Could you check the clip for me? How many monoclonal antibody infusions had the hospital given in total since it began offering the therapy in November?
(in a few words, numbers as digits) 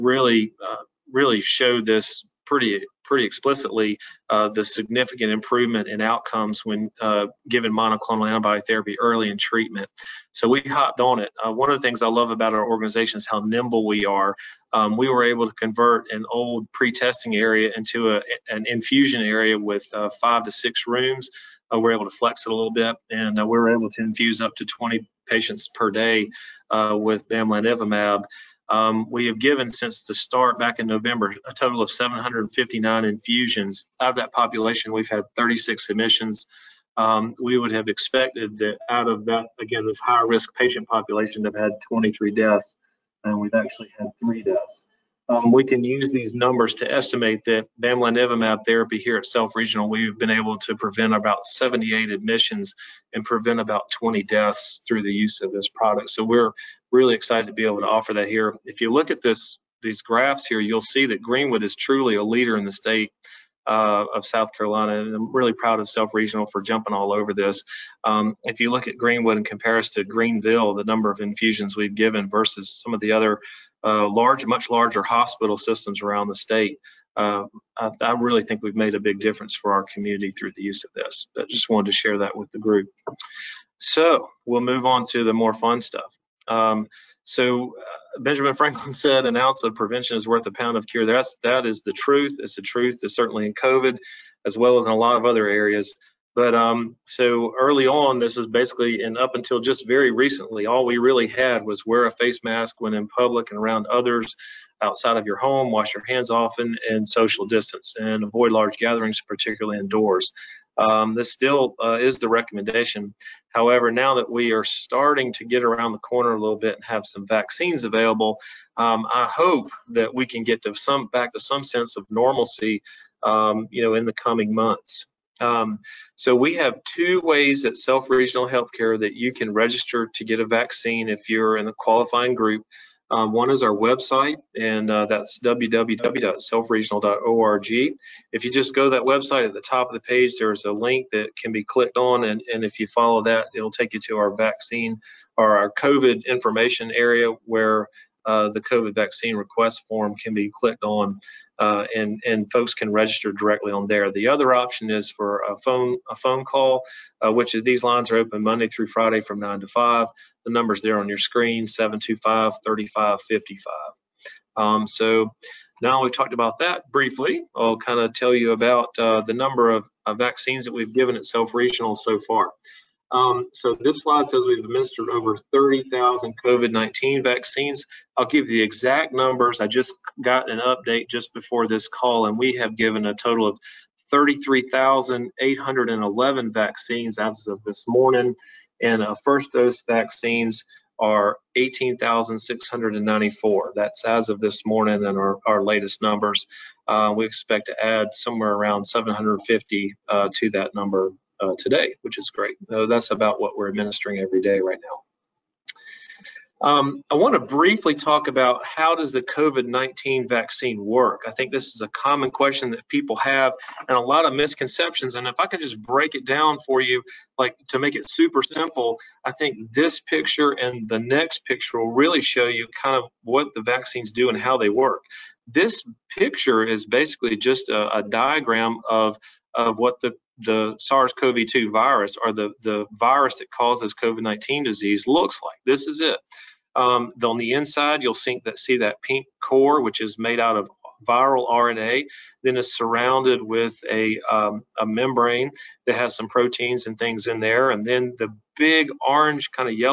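759.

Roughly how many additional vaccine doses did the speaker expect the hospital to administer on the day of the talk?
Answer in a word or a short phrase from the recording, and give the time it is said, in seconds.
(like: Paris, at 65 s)
750, at 198 s.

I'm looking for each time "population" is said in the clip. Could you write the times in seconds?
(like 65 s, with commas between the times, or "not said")
34 s, 40 s.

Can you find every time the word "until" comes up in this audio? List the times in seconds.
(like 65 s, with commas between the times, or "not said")
99 s.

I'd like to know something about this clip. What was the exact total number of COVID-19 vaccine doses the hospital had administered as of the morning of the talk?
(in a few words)
33,811.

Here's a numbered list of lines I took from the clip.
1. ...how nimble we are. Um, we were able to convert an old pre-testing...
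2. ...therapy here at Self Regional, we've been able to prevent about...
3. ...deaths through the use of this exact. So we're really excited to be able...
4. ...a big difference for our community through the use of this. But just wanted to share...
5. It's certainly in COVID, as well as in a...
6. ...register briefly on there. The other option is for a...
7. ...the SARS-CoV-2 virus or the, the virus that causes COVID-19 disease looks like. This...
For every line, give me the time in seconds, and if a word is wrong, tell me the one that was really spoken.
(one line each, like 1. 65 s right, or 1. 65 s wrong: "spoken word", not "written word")
1. 13 s right
2. 48 s right
3. 54 s wrong: "product", not "exact"
4. 78 s right
5. 93 s right
6. 152 s wrong: "directly", not "briefly"
7. 230 s right.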